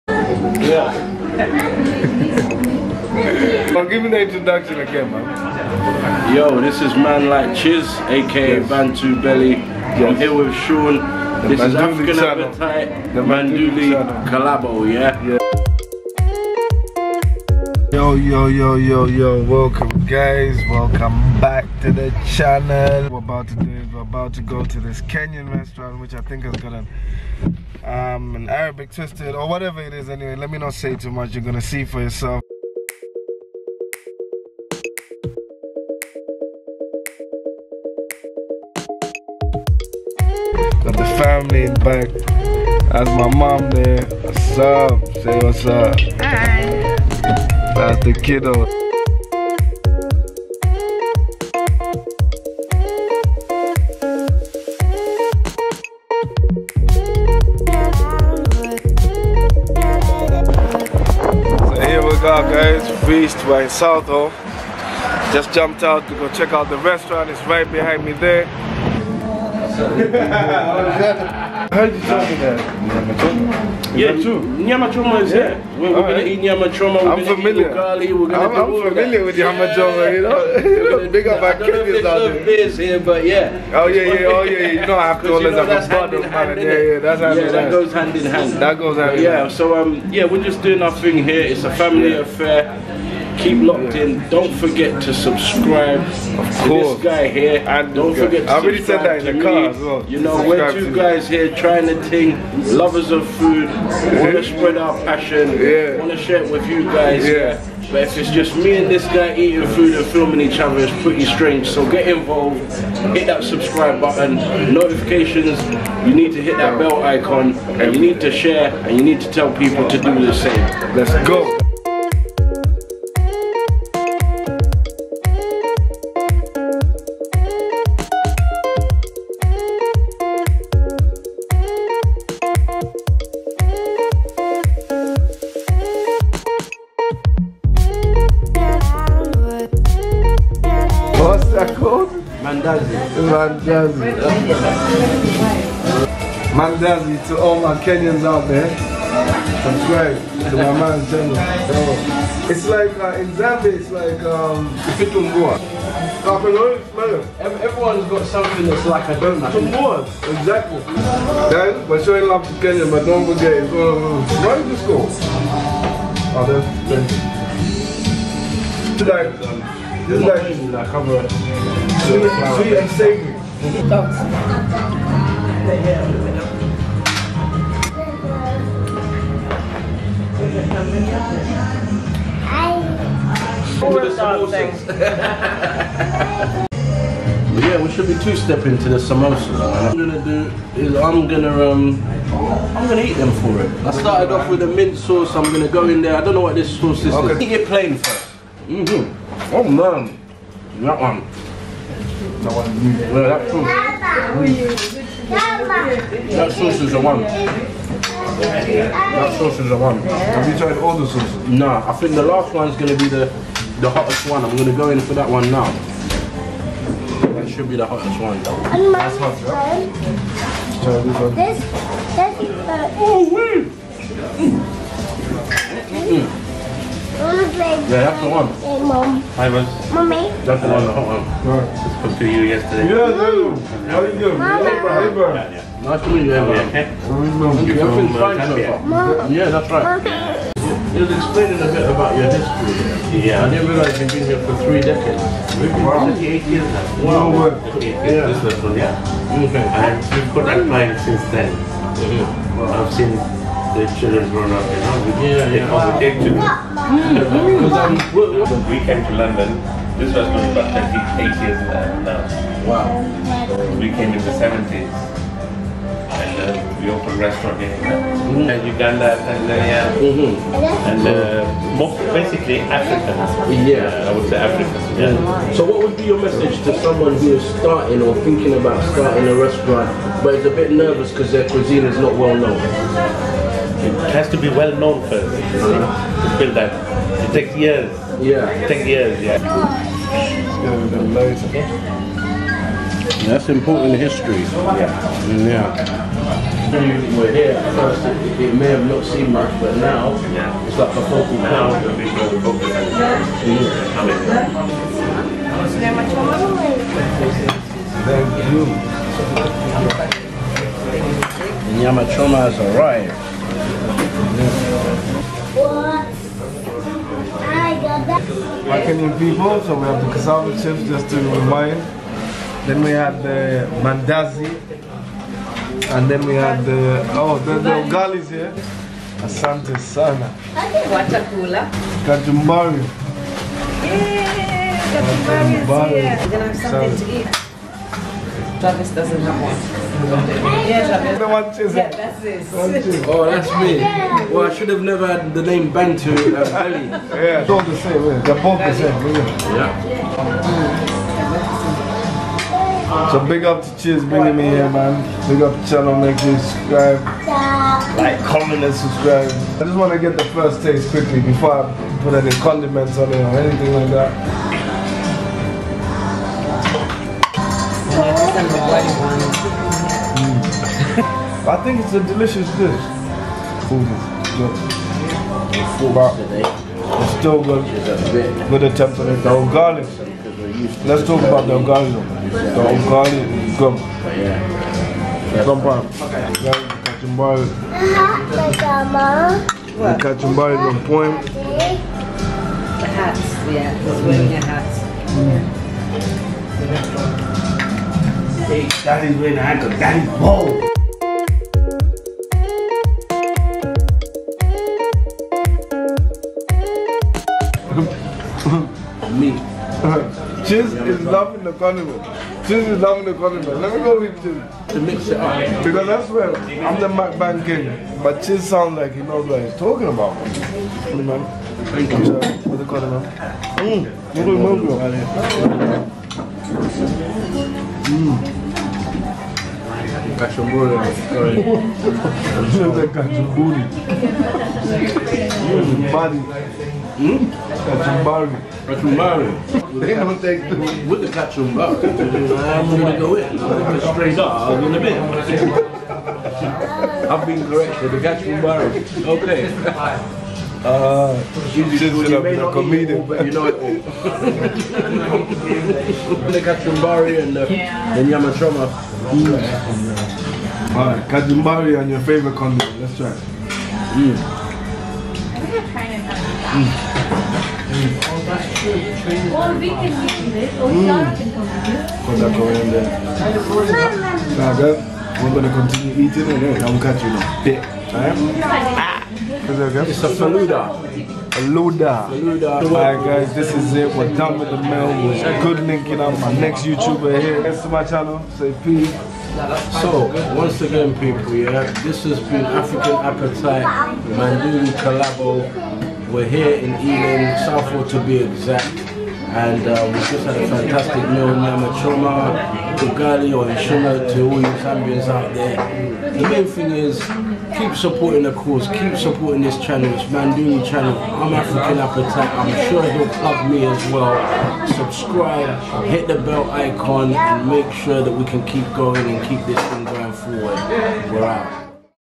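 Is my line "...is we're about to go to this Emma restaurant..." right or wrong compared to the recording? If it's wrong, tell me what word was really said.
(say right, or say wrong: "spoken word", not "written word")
wrong: "Kenyan", not "Emma".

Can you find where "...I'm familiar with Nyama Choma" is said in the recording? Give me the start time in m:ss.
1:18.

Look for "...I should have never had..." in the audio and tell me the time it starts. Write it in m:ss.
5:44.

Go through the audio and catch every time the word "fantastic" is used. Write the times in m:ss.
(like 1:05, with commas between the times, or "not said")
8:20.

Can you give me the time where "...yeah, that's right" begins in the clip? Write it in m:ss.
3:59.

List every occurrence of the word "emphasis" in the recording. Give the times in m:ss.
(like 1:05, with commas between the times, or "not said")
not said.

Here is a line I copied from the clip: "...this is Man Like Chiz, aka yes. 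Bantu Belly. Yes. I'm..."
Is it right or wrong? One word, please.
right.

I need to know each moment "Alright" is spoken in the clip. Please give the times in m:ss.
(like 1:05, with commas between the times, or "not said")
7:40, 7:57, 8:02.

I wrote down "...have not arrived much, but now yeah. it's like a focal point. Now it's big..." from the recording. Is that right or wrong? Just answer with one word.
wrong.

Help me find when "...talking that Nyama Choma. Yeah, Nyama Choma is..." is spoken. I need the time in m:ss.
1:12.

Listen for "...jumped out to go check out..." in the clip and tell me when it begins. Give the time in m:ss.
1:05.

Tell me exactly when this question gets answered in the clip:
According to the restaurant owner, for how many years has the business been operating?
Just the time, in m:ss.
4:06.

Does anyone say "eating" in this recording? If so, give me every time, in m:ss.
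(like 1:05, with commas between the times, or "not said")
1:49, 7:56.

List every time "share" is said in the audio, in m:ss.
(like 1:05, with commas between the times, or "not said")
1:46, 1:58.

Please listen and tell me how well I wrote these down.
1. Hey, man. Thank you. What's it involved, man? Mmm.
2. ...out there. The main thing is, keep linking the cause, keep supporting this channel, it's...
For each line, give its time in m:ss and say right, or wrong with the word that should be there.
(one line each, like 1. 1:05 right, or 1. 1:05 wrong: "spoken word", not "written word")
1. 7:00 wrong: "called", not "involved"
2. 8:25 wrong: "supporting", not "linking".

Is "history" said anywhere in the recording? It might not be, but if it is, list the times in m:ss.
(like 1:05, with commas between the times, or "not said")
4:02, 4:53.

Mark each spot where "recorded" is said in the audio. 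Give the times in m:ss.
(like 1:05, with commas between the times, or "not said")
not said.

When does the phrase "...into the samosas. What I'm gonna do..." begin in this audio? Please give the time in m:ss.
3:08.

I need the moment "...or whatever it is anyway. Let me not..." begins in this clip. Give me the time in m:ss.
0:29.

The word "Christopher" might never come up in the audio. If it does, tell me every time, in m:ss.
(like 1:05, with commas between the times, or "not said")
not said.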